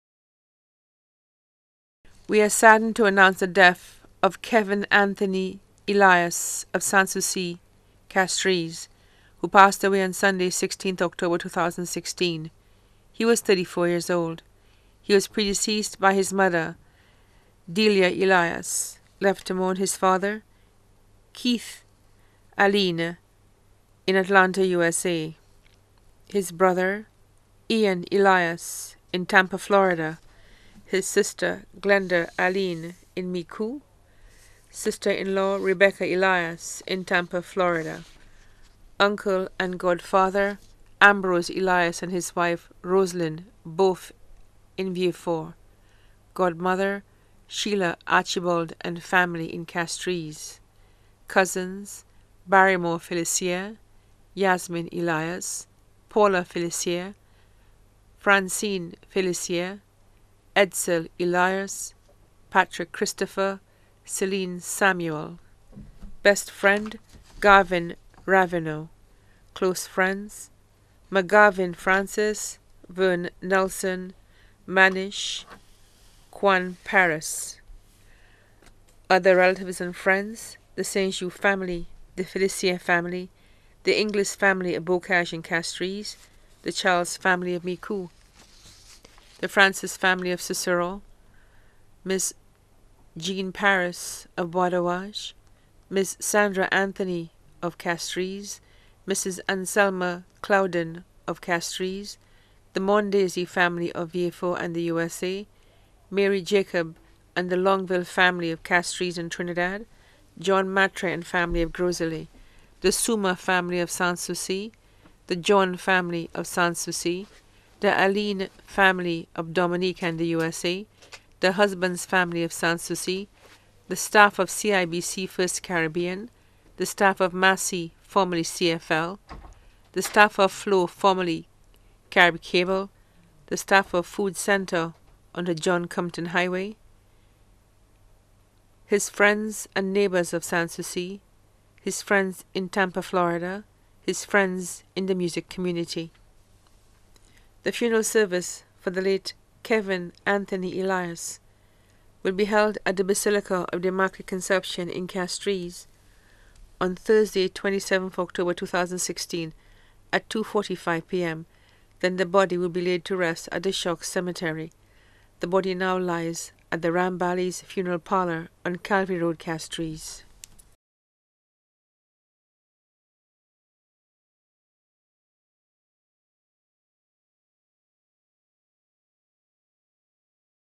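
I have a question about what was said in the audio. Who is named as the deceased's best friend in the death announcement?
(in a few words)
Gavin Ravenel.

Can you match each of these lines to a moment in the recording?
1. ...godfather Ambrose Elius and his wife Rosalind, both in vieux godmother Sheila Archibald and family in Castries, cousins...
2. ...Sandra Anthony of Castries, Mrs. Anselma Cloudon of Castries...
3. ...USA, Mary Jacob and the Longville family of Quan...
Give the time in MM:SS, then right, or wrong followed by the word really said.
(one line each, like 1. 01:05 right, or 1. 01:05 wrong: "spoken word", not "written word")
1. 00:39 right
2. 01:36 right
3. 01:44 wrong: "Castries", not "Quan".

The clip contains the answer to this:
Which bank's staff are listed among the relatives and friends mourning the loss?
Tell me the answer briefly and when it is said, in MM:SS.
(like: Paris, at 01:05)
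CIBC First Caribbean, at 02:04.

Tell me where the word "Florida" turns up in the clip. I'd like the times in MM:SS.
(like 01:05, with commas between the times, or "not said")
00:29, 00:37, 02:23.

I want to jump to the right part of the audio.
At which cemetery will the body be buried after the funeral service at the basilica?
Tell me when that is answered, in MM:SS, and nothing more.
02:43.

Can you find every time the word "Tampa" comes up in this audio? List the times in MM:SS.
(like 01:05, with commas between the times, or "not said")
00:29, 00:37, 02:22.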